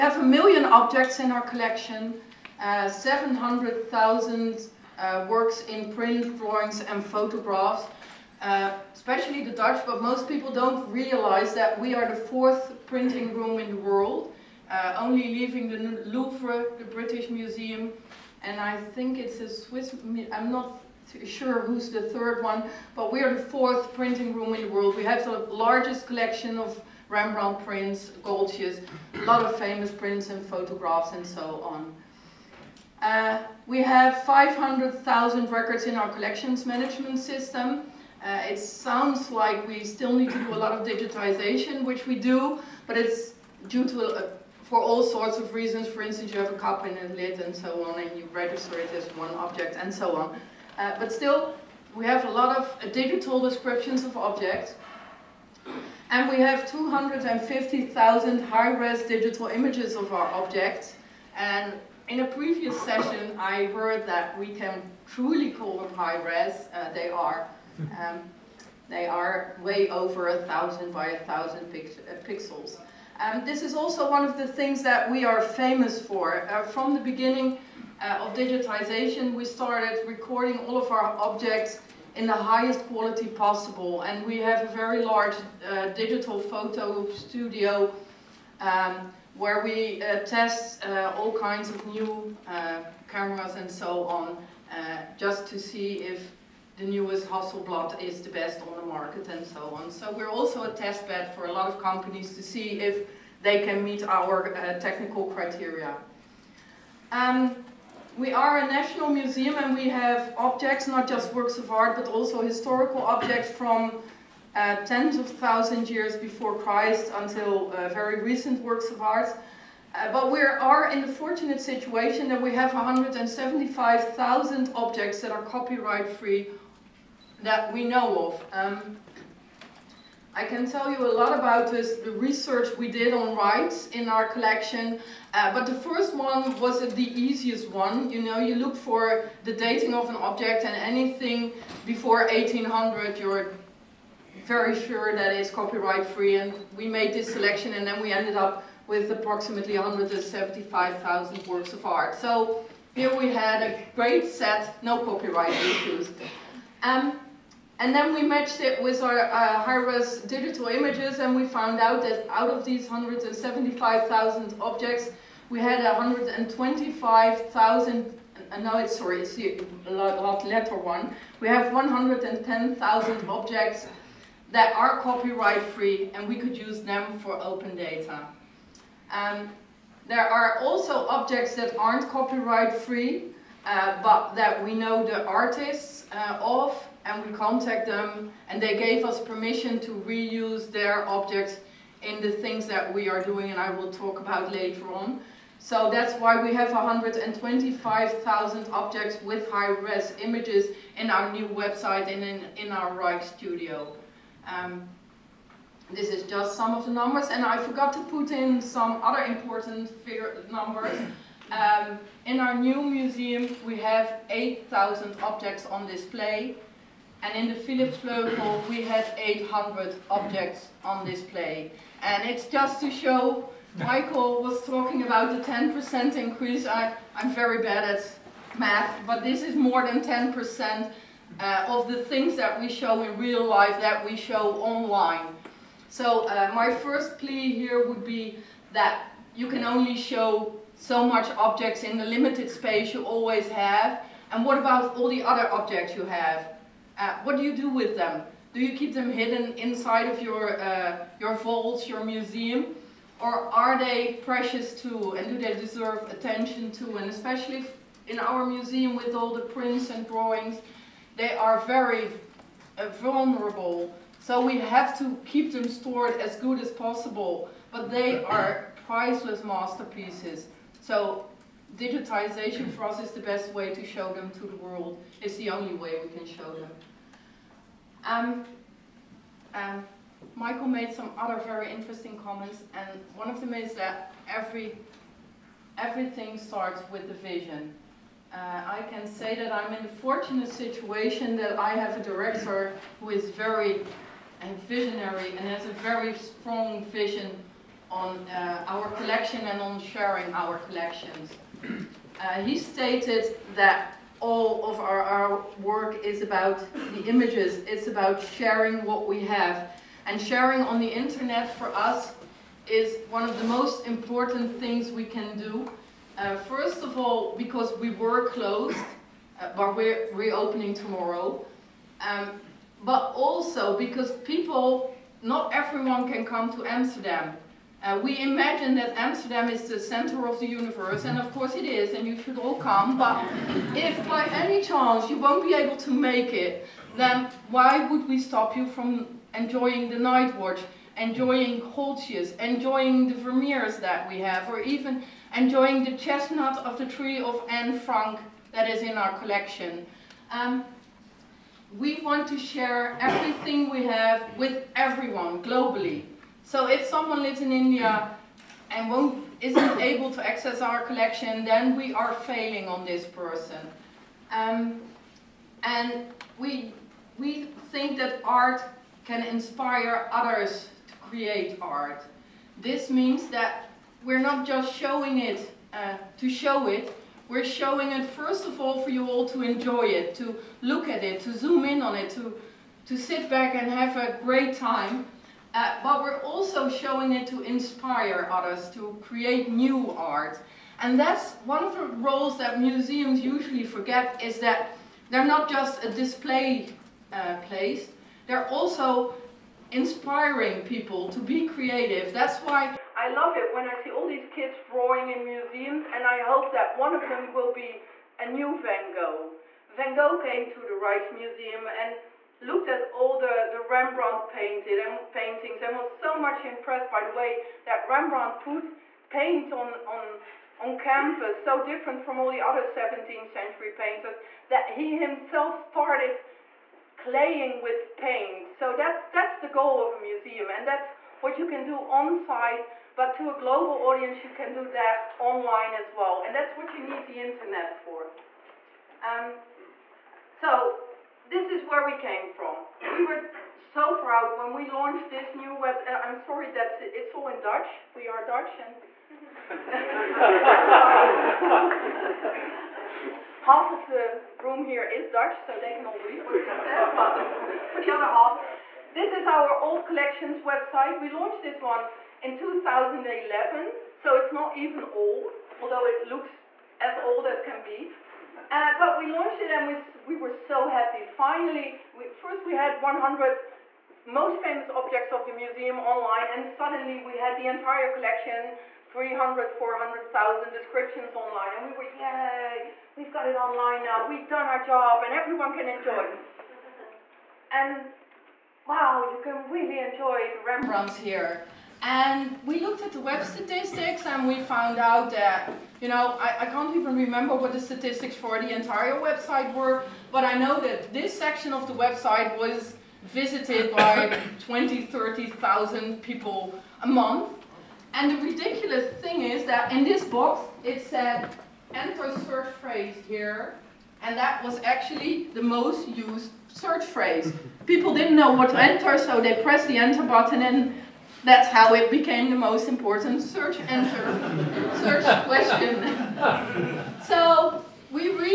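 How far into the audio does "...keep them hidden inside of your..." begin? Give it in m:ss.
4:08.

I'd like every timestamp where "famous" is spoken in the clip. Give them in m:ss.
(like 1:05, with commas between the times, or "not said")
0:29, 1:15, 7:54.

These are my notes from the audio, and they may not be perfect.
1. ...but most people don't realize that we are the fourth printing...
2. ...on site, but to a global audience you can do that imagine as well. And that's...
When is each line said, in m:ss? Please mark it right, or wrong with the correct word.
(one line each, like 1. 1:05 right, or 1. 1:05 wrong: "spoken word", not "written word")
1. 0:09 right
2. 7:11 wrong: "online", not "imagine".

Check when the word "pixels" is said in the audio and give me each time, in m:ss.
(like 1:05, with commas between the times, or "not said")
1:12.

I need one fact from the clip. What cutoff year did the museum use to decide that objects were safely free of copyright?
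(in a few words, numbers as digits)
1800.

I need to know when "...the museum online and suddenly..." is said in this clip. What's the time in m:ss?
7:55.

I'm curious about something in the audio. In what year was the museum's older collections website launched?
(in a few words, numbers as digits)
2011.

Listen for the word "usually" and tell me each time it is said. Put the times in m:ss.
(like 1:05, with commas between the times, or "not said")
6:33.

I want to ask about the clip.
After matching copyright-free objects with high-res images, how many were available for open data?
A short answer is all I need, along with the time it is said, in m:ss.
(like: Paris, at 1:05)
110,000, at 2:51.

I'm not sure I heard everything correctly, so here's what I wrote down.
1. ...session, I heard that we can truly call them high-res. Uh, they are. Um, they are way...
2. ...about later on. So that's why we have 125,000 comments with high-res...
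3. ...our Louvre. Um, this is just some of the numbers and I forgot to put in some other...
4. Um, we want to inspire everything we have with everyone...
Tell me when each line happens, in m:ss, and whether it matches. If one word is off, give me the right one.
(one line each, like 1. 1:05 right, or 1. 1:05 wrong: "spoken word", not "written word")
1. 1:02 right
2. 3:14 wrong: "objects", not "comments"
3. 3:22 wrong: "Rijksstudio", not "Louvre"
4. 5:50 wrong: "share", not "inspire".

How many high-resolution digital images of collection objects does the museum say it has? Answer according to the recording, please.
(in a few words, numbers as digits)
250,000.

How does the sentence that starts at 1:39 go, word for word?
So we're also a test bed for a lot of companies to see if they can meet our uh, technical criteria.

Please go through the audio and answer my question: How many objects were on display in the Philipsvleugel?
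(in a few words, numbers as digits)
800.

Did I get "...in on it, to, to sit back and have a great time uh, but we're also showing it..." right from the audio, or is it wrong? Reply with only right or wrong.
right.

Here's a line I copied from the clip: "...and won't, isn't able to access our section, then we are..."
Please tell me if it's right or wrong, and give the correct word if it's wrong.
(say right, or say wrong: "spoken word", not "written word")
wrong: "collection", not "section".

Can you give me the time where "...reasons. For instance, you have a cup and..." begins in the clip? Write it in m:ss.
0:45.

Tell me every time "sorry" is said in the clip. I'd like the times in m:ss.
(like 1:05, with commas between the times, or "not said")
2:48, 7:26.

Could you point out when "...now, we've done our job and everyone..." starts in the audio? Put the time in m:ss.
8:03.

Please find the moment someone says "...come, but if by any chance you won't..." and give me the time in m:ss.
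5:32.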